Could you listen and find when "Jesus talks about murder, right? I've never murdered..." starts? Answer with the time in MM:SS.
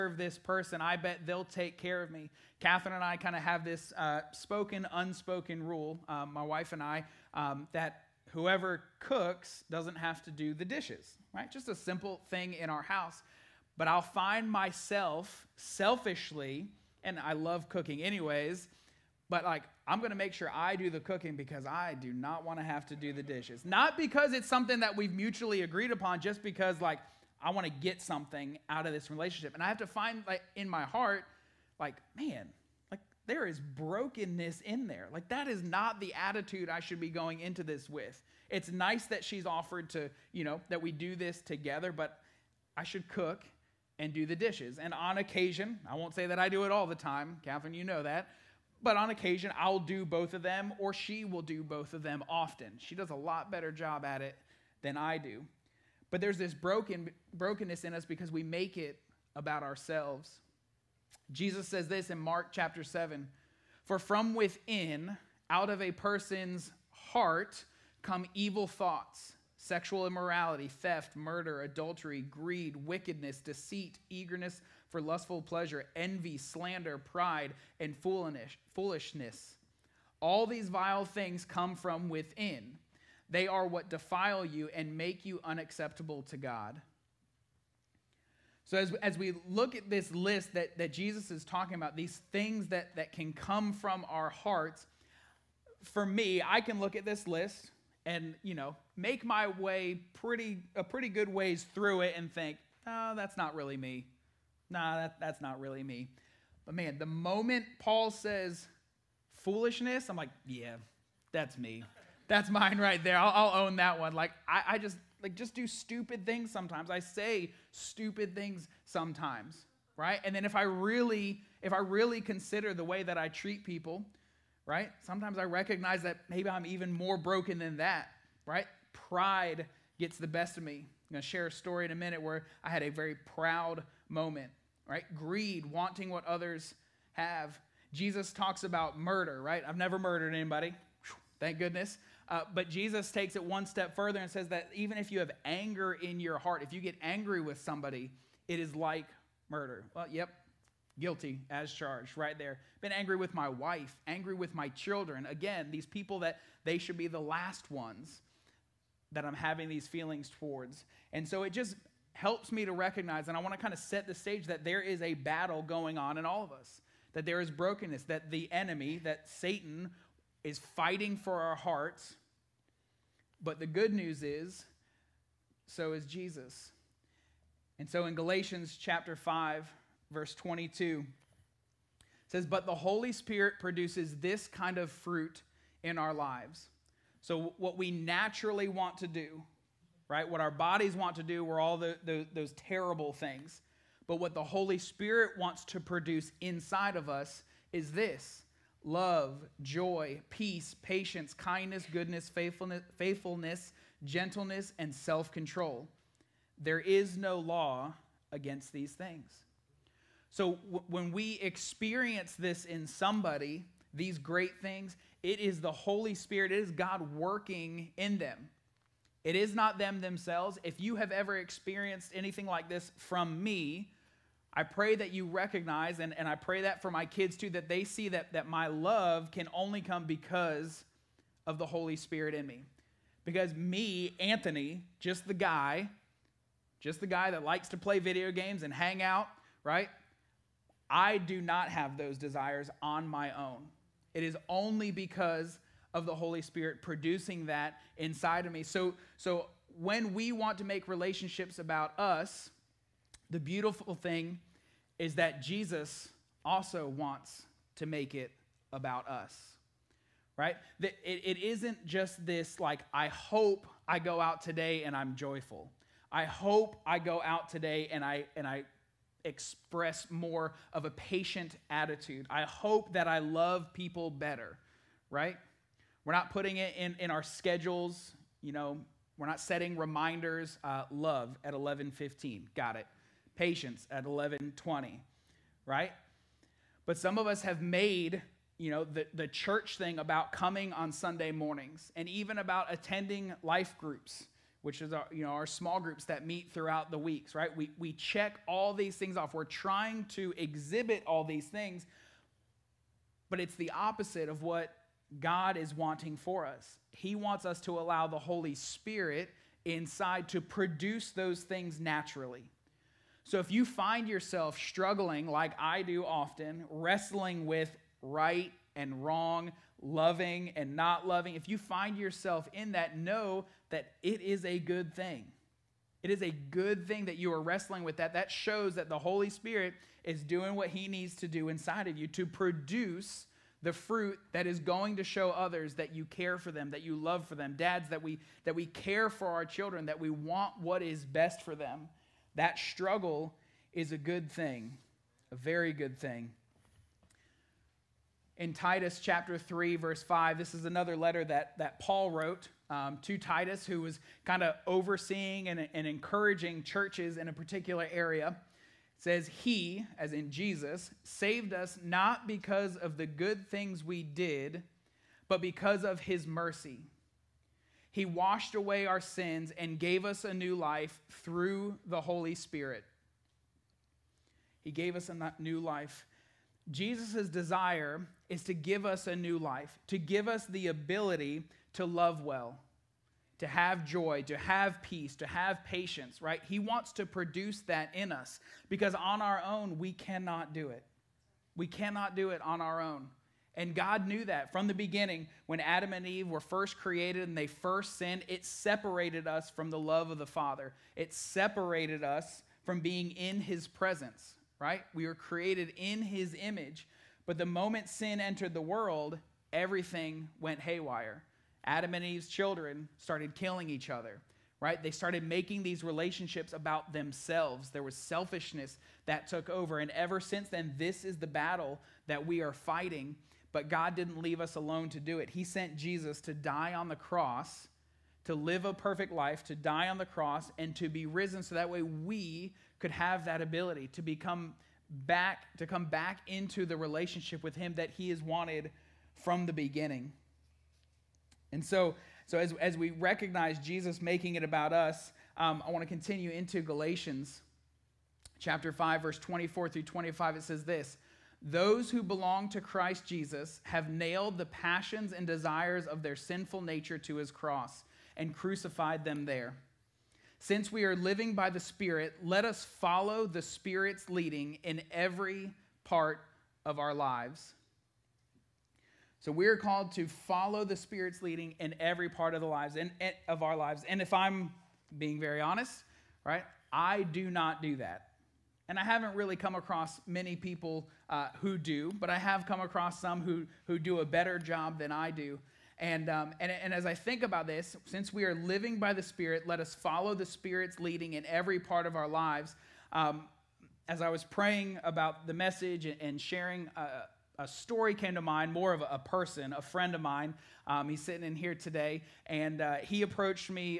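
02:17.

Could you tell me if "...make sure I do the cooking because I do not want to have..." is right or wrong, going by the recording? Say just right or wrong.
right.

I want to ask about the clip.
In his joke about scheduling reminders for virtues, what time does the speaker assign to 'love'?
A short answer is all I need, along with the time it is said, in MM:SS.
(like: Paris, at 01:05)
11:15, at 04:41.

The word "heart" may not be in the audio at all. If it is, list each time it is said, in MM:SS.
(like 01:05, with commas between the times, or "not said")
00:30, 01:06, 01:34, 02:26, 02:51.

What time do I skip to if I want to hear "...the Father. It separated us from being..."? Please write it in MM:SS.
06:40.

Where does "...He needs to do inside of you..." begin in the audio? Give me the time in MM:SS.
05:30.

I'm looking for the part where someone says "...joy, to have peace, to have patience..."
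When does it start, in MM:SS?
06:23.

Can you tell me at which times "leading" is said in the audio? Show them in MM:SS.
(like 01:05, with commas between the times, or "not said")
07:44, 07:51, 08:10.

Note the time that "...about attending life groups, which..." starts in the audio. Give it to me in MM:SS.
04:52.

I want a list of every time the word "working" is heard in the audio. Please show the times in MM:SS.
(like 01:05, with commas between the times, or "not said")
03:37.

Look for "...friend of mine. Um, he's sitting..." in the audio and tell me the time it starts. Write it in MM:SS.
08:19.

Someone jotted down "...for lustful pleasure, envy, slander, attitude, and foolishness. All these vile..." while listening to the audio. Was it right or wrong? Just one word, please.
wrong.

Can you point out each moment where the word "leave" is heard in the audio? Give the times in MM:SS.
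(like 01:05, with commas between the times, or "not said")
07:04.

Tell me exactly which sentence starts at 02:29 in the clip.
Well, yep, guilty as charged right there.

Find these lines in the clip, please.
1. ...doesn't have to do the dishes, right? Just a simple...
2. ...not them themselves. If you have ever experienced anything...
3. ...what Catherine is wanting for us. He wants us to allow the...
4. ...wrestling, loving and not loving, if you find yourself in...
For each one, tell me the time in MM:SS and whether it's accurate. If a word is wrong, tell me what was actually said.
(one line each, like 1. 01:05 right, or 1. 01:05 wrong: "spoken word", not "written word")
1. 00:09 right
2. 03:39 right
3. 05:04 wrong: "God", not "Catherine"
4. 05:19 wrong: "wrong", not "wrestling".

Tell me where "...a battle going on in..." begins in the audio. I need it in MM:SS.
02:45.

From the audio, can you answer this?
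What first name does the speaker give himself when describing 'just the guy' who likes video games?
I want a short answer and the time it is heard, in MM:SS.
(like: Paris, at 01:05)
Anthony, at 03:54.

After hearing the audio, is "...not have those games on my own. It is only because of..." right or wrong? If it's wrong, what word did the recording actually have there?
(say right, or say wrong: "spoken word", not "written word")
wrong: "desires", not "games".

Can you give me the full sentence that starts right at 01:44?
Nah, that, that's not really me.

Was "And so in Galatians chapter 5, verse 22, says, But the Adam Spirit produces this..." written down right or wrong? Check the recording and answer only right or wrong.
wrong.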